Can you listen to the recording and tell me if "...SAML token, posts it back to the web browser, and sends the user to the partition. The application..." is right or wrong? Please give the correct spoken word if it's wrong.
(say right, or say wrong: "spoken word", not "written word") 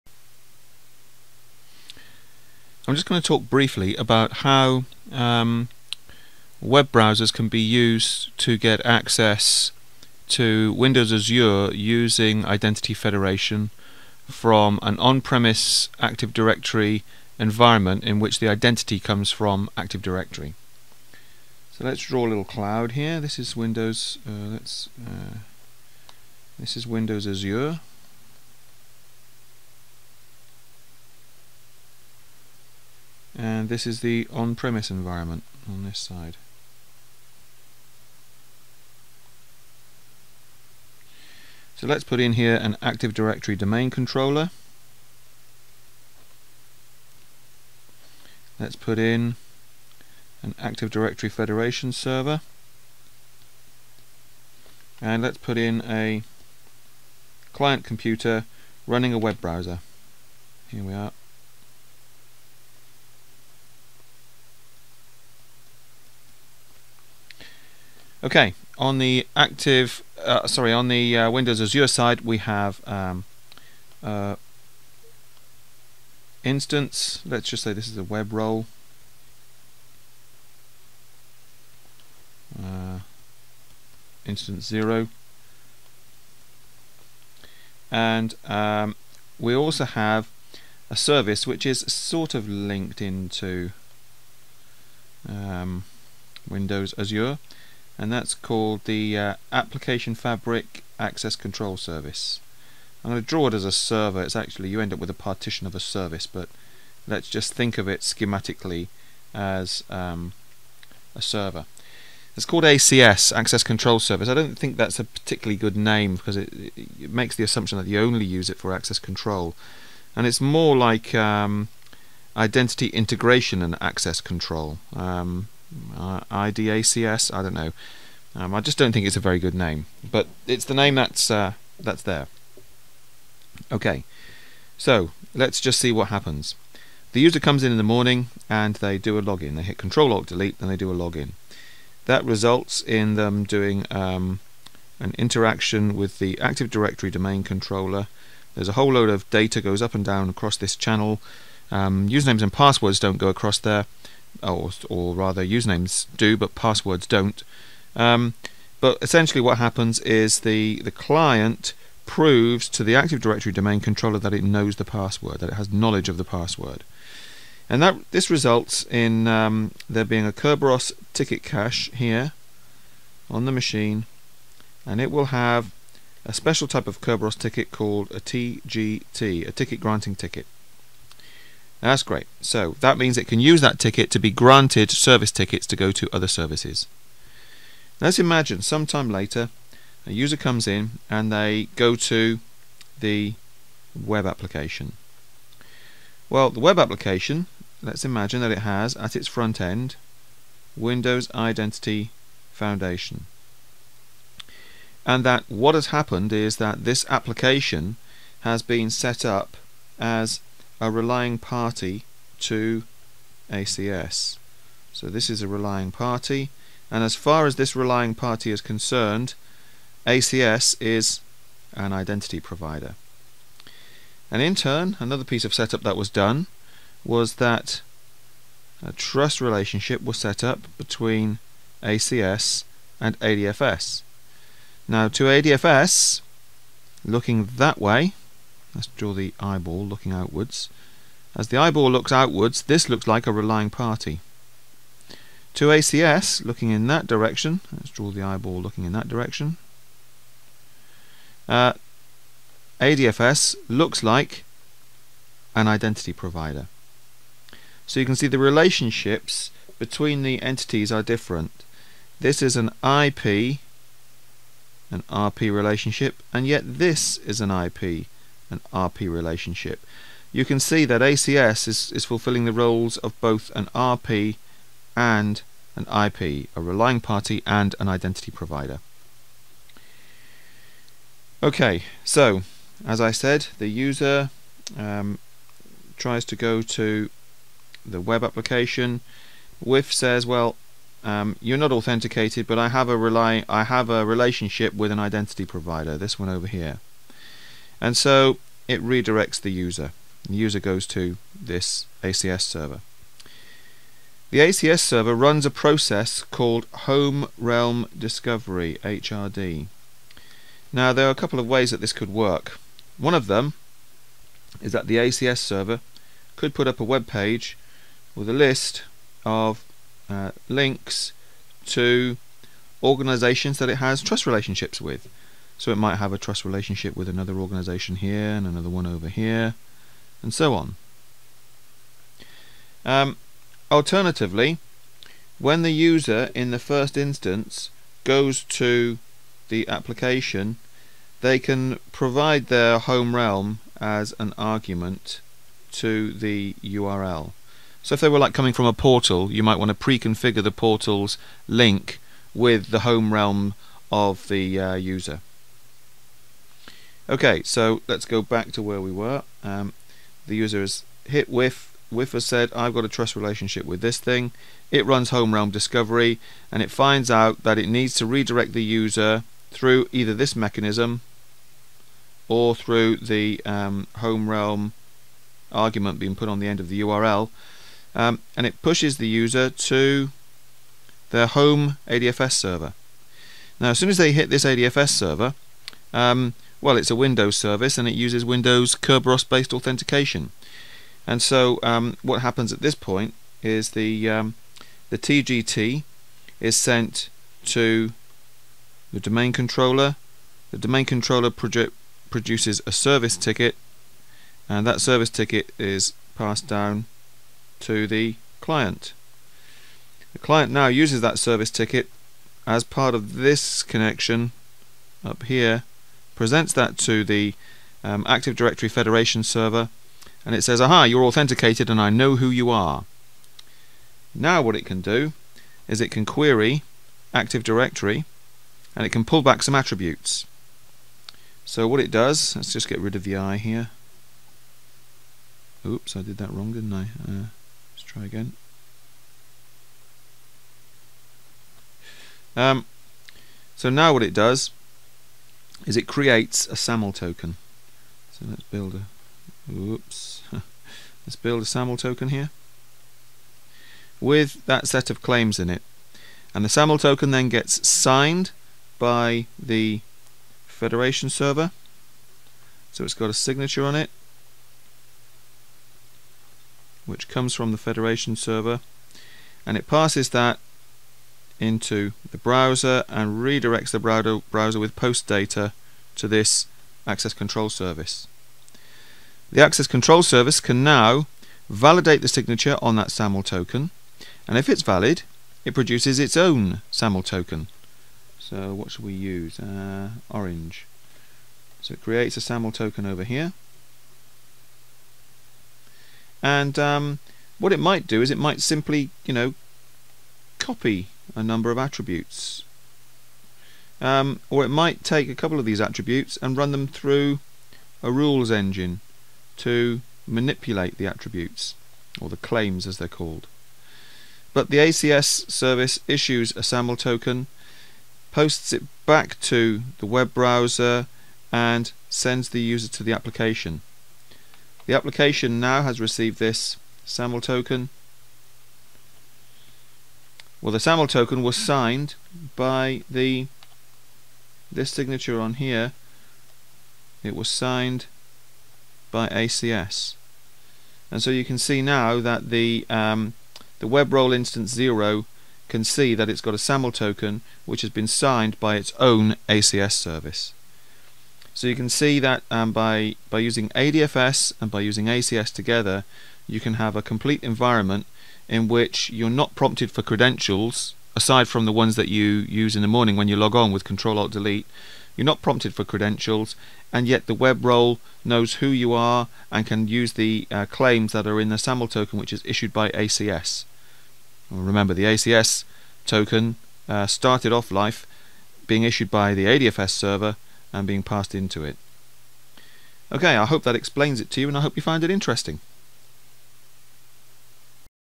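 wrong: "application", not "partition".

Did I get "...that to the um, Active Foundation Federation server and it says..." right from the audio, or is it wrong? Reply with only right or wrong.
wrong.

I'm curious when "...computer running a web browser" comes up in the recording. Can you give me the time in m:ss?
0:57.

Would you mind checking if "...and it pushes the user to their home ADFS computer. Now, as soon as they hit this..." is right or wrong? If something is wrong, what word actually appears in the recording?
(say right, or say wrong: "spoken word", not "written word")
wrong: "server", not "computer".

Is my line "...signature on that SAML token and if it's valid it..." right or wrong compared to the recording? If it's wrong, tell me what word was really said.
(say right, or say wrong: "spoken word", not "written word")
right.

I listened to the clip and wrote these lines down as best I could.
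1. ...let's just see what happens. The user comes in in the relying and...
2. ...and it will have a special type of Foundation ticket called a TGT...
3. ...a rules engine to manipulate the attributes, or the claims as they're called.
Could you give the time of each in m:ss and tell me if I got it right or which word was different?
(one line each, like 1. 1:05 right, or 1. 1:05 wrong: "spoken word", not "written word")
1. 2:15 wrong: "morning", not "relying"
2. 2:54 wrong: "Kerberos", not "Foundation"
3. 8:27 right.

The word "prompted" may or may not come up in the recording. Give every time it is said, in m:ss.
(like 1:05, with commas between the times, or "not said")
9:19, 9:25.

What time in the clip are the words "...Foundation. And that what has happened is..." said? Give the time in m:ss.
3:22.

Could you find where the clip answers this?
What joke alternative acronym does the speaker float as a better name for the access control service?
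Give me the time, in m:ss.
2:06.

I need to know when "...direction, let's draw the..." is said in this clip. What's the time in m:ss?
4:07.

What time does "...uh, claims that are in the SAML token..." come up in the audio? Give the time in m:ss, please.
9:30.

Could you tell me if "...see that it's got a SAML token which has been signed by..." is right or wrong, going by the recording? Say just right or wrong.
right.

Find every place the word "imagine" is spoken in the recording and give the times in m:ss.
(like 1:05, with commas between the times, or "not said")
3:08, 3:18.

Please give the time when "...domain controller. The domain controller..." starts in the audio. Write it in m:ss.
6:38.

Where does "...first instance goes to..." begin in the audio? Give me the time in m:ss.
5:36.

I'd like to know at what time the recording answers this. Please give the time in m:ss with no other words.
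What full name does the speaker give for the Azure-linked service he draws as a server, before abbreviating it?
1:39.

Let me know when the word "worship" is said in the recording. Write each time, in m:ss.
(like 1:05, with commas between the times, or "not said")
not said.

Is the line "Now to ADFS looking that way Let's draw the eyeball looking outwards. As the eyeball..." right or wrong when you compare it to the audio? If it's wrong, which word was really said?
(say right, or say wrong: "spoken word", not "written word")
right.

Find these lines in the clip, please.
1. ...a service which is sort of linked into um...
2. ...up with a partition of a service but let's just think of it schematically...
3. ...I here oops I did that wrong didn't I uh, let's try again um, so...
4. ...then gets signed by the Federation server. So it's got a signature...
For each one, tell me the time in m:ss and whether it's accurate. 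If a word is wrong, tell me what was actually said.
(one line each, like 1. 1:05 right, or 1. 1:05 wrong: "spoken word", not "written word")
1. 1:30 right
2. 1:44 right
3. 7:13 right
4. 7:37 right.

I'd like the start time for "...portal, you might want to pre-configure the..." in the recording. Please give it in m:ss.
5:48.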